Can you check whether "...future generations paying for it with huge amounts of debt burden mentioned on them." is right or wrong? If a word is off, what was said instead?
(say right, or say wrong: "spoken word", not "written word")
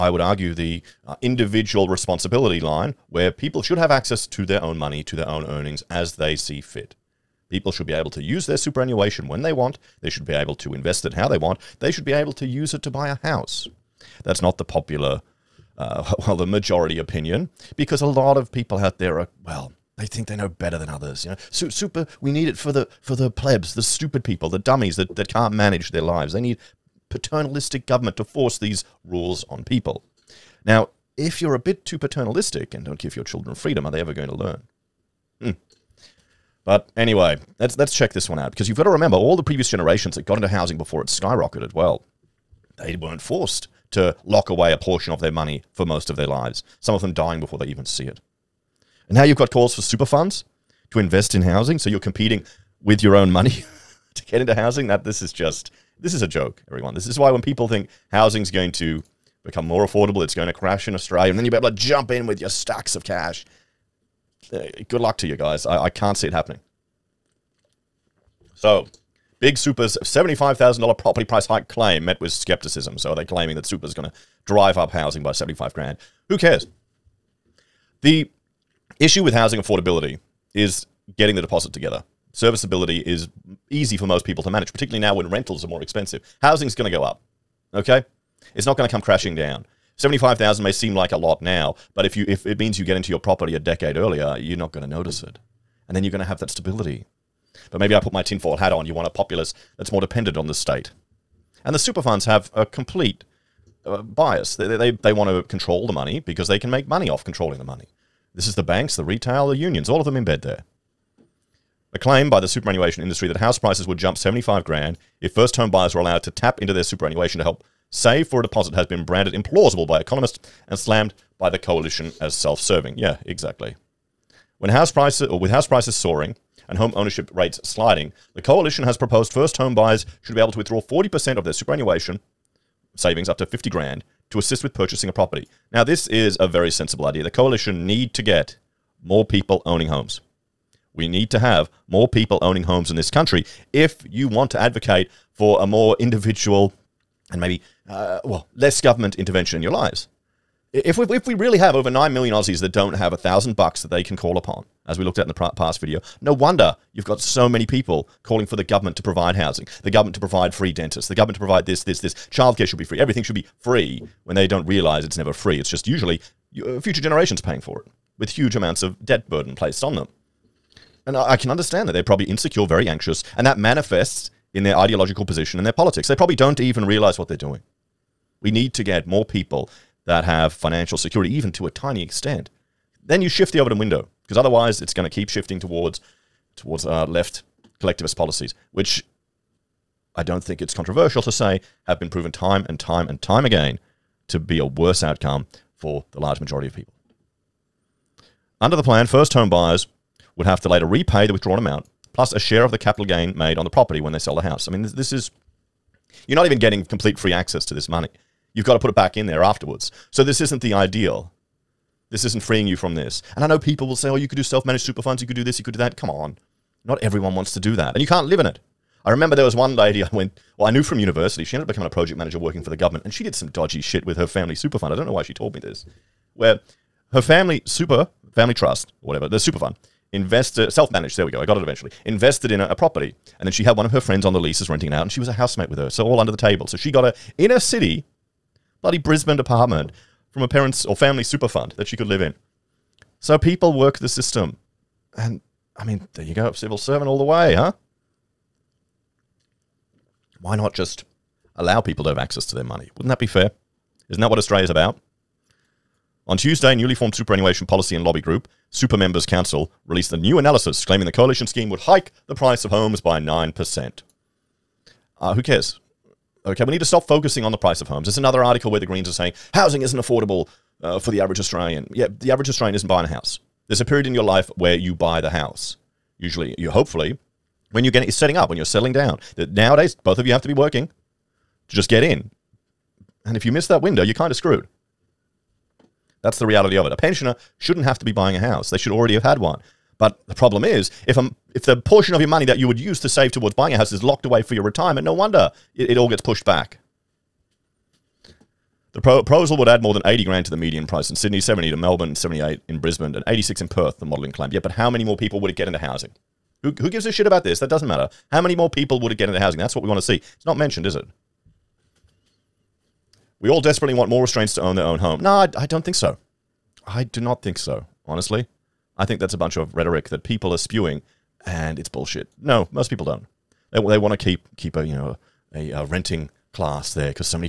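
wrong: "placed", not "mentioned".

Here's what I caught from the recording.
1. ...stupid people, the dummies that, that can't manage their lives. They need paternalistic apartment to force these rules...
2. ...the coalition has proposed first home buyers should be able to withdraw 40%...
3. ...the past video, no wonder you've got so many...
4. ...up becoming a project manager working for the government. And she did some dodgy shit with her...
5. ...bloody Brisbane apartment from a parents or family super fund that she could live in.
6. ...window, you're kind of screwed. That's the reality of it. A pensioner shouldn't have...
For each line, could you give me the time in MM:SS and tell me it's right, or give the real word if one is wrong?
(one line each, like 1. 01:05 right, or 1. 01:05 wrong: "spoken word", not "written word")
1. 00:23 wrong: "government", not "apartment"
2. 02:08 right
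3. 02:35 right
4. 03:41 right
5. 03:58 right
6. 04:43 right.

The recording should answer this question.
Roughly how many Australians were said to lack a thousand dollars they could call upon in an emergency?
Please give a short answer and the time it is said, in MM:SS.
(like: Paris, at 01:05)
9 million, at 02:31.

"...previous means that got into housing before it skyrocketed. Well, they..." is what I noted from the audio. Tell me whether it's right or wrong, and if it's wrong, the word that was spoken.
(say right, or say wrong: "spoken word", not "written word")
wrong: "generations", not "means".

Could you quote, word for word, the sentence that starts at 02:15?
Now, this is a very sensible idea.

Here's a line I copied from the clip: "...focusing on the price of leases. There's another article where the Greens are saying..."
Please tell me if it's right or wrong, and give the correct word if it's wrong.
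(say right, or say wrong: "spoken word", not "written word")
wrong: "homes", not "leases".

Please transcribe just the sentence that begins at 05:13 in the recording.
We all desperately want more Australians to own their own home.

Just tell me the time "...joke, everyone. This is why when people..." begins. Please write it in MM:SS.
00:56.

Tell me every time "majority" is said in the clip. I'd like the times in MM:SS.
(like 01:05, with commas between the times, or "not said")
00:16, 03:16.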